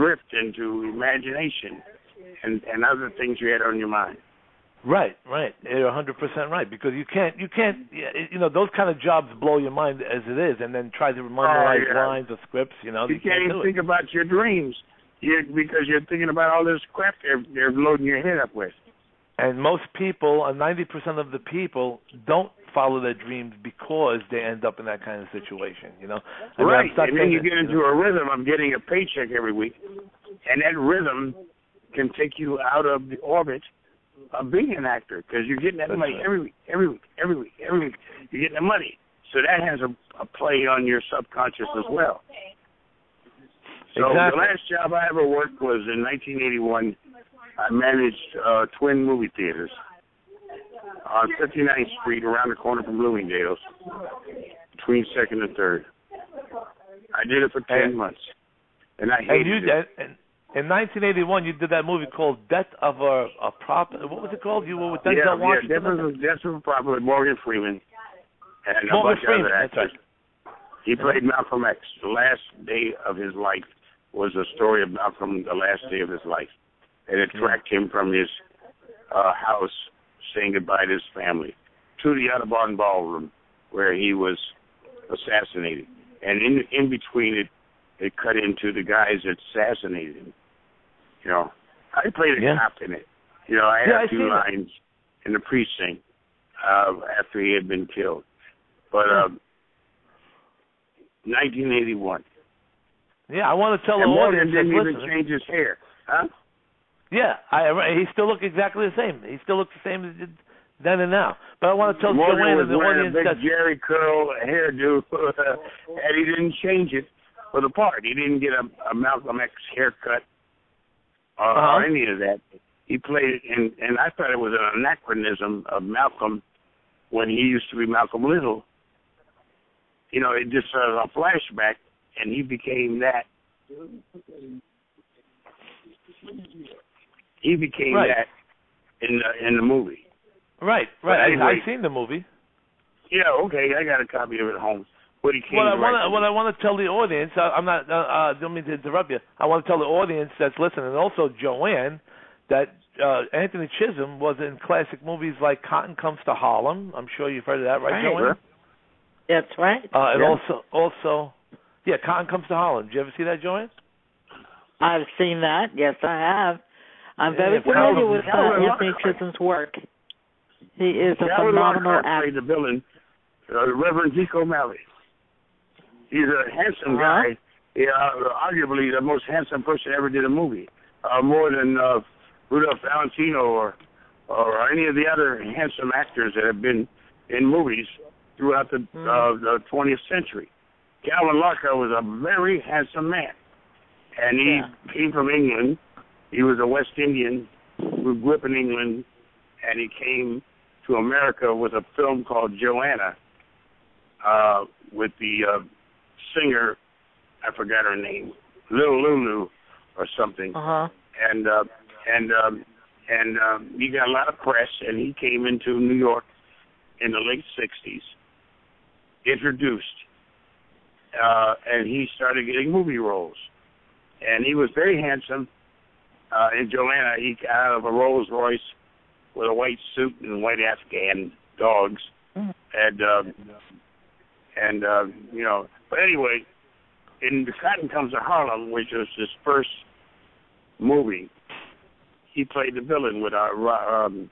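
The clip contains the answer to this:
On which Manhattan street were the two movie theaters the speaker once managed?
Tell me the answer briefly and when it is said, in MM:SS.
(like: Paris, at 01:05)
59th Street, at 00:51.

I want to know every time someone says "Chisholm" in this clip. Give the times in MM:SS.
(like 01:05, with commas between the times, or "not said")
02:33, 02:49.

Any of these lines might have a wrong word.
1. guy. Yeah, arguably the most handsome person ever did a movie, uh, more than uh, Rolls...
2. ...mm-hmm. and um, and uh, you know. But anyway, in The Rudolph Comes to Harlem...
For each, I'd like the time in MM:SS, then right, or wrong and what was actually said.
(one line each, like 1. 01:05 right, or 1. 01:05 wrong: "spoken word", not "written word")
1. 02:57 wrong: "Rudolph", not "Rolls"
2. 03:52 wrong: "Cotton", not "Rudolph".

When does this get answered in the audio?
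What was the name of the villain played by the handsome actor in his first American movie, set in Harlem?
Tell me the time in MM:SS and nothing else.
02:53.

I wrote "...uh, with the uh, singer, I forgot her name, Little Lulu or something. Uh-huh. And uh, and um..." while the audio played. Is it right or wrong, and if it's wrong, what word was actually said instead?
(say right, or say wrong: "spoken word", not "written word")
right.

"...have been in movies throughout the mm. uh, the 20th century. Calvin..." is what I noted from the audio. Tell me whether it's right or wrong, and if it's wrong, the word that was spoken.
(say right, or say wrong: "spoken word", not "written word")
right.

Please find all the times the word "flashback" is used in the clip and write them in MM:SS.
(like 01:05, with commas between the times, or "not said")
02:11.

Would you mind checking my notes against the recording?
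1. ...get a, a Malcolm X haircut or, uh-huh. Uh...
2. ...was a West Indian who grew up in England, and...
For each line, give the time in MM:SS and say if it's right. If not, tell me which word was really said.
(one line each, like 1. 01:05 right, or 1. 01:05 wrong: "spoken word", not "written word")
1. 01:58 right
2. 03:16 right.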